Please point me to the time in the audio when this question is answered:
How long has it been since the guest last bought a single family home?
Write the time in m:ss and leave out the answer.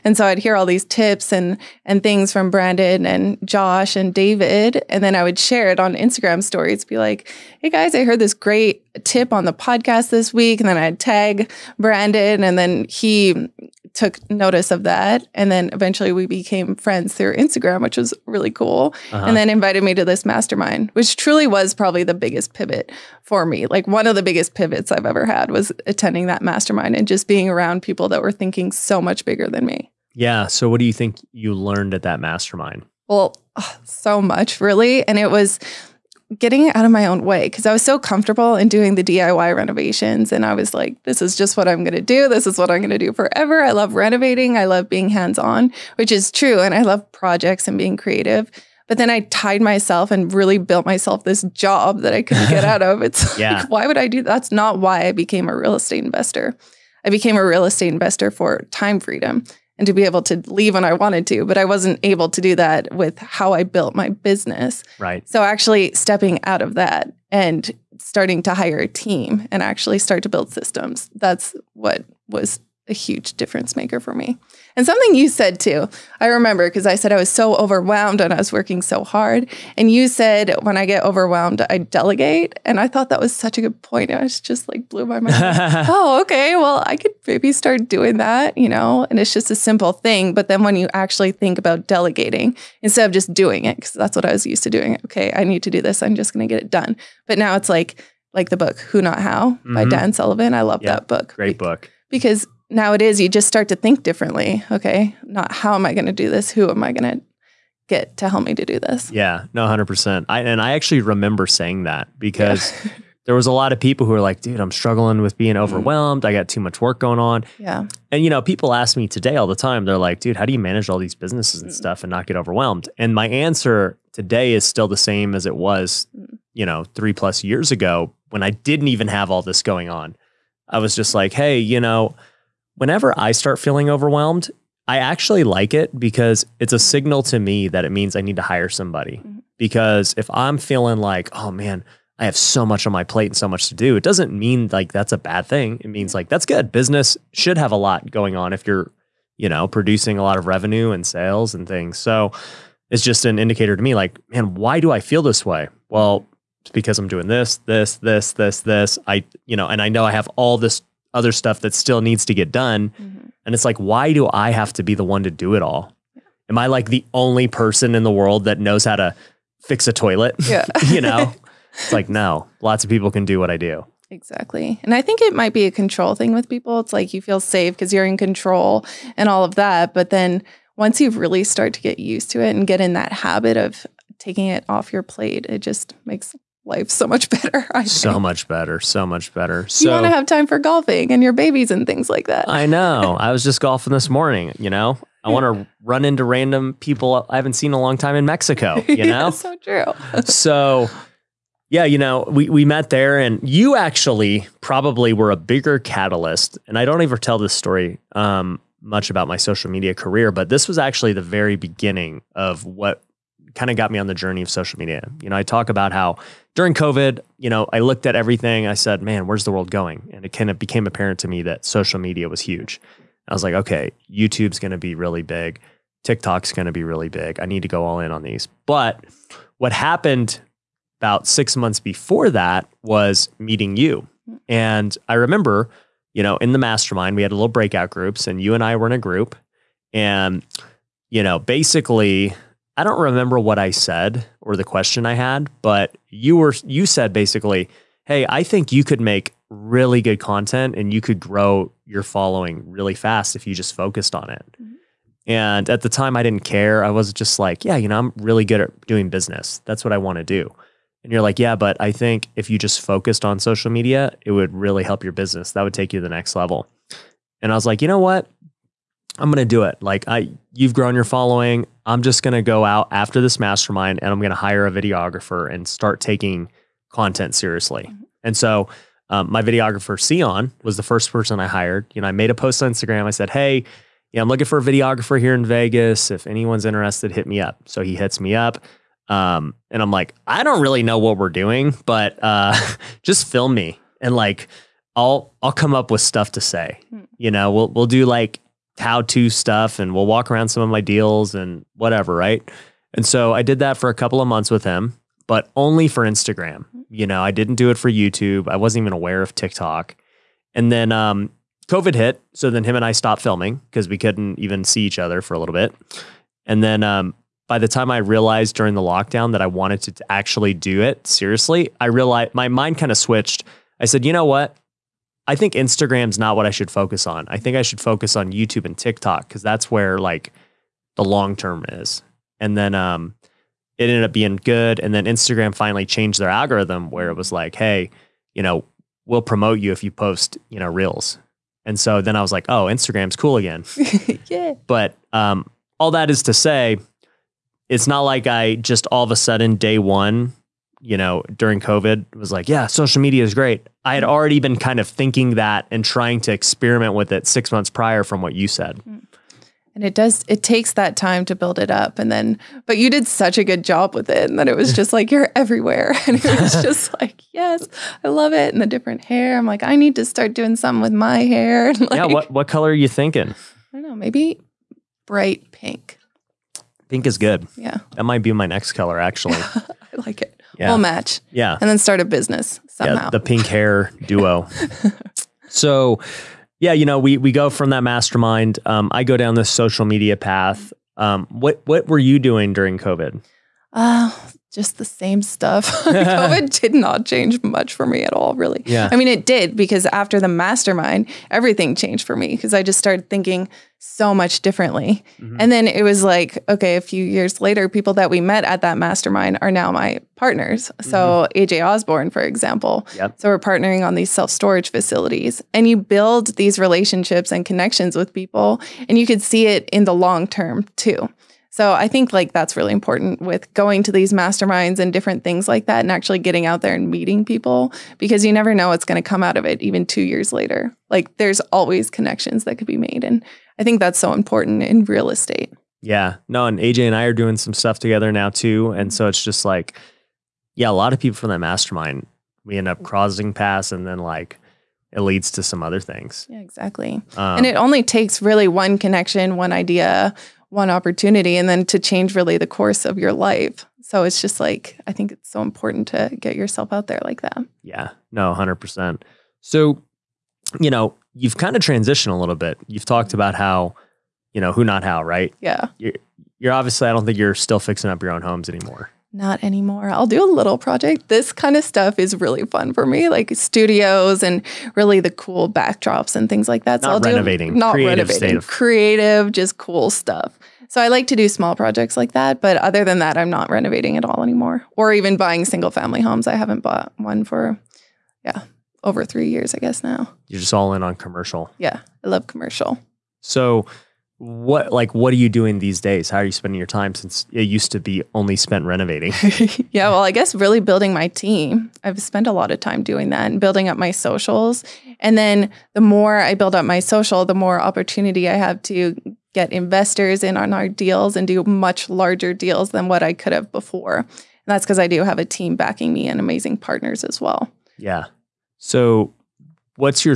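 8:08.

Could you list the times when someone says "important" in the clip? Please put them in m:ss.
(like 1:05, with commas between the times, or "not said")
7:02, 7:14, 7:35.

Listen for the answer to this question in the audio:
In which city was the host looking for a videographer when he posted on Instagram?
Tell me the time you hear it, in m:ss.
4:45.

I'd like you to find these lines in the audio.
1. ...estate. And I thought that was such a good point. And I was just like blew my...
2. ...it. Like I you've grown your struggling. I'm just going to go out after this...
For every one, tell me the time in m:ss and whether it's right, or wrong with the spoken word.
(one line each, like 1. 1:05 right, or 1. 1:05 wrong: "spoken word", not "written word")
1. 1:21 wrong: "delegate", not "estate"
2. 4:29 wrong: "following", not "struggling".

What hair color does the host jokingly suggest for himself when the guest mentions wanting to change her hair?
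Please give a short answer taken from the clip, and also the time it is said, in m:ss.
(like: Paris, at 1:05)
Bright pink, at 6:15.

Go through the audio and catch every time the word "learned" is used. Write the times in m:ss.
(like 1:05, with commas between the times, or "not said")
0:31.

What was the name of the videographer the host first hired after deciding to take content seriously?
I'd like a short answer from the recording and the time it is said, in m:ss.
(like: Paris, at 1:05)
Sion, at 4:39.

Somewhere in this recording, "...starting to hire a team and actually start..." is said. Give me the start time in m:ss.
1:07.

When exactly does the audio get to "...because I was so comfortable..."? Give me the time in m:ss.
0:37.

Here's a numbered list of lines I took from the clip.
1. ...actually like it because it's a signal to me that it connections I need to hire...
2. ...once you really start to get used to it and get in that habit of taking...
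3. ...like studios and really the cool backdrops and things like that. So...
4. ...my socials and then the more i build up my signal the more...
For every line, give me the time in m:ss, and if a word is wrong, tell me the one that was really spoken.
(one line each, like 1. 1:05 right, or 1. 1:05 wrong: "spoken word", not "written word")
1. 2:14 wrong: "means", not "connections"
2. 3:00 right
3. 7:53 right
4. 8:23 wrong: "social", not "signal".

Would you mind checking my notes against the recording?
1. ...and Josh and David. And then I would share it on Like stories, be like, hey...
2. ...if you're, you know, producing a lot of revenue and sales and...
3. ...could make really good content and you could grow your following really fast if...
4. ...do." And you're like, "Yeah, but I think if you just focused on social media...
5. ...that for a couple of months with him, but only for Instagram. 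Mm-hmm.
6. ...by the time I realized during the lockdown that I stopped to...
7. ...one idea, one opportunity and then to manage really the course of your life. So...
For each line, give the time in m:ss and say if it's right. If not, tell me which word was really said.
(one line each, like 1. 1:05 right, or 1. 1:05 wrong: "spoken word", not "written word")
1. 0:03 wrong: "Instagram", not "Like"
2. 2:28 right
3. 4:08 right
4. 4:20 right
5. 5:03 right
6. 5:17 wrong: "wanted", not "stopped"
7. 7:29 wrong: "change", not "manage".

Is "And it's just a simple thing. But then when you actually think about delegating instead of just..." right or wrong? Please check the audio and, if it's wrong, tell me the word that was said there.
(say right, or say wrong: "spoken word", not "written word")
right.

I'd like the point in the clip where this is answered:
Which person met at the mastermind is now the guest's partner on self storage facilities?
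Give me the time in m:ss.
6:51.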